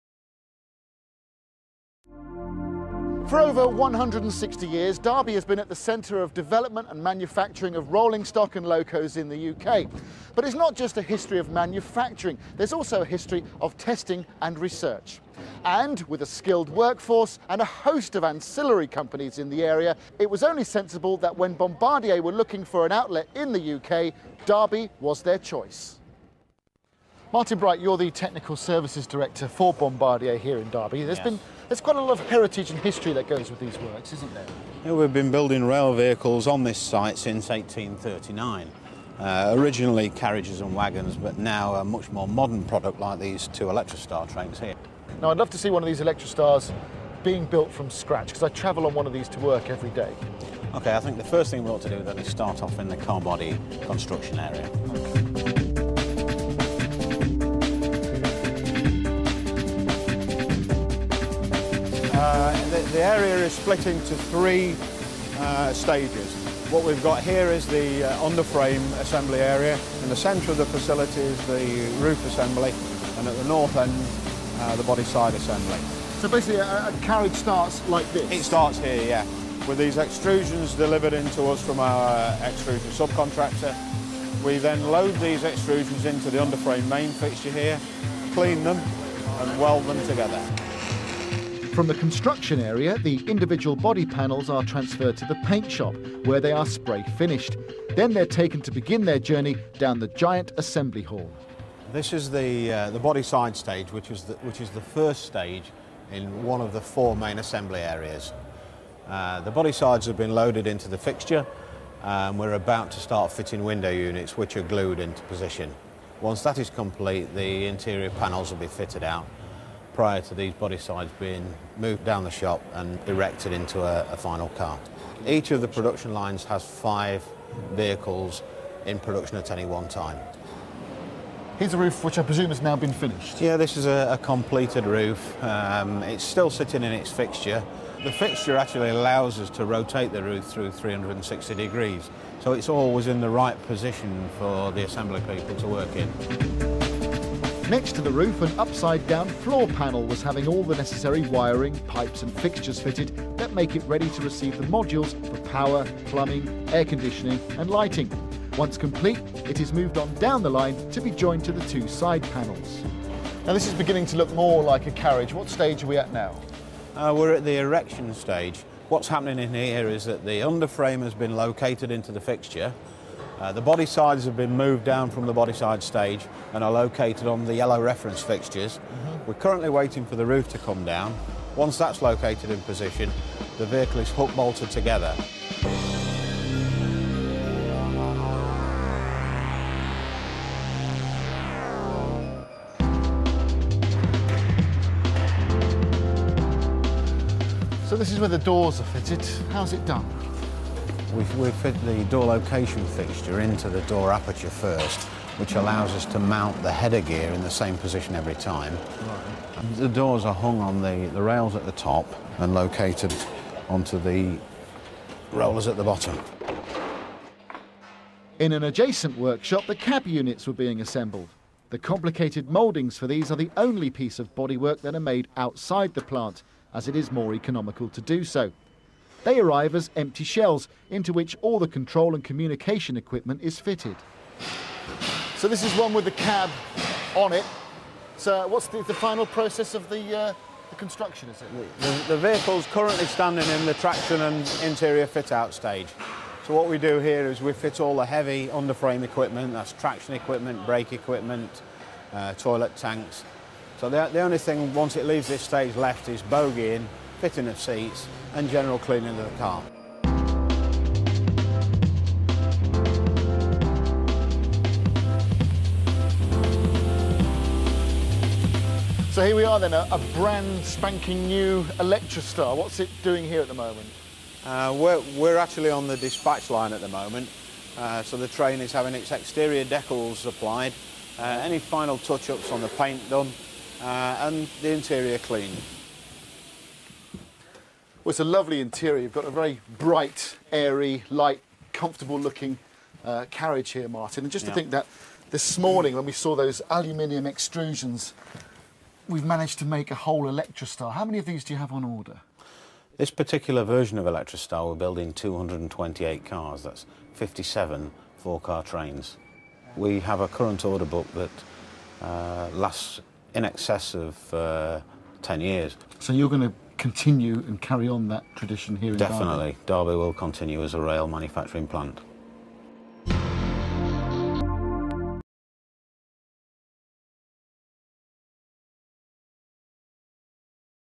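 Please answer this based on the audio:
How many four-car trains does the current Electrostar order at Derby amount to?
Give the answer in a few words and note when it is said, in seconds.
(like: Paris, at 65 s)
57, at 307 s.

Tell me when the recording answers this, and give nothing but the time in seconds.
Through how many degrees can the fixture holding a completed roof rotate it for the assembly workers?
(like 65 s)
140 s.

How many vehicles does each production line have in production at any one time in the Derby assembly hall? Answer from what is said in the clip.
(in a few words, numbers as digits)
5.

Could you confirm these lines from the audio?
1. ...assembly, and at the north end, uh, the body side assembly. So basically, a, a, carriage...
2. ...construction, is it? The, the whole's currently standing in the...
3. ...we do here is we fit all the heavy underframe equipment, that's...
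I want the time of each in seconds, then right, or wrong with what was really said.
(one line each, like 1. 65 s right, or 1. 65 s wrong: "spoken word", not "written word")
1. 72 s right
2. 240 s wrong: "vehicle", not "whole"
3. 246 s right.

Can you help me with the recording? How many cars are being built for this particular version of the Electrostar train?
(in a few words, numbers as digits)
228.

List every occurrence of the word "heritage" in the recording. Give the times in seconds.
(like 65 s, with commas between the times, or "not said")
32 s.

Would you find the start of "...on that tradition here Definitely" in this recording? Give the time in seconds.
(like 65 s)
317 s.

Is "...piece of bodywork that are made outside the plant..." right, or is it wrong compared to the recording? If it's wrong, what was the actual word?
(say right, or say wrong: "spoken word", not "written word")
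right.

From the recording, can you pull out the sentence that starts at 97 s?
Then they're taken to begin their journey down the giant assembly hall.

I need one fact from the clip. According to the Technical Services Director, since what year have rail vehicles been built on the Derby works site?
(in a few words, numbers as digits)
1839.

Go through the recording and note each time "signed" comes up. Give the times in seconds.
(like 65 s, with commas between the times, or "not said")
not said.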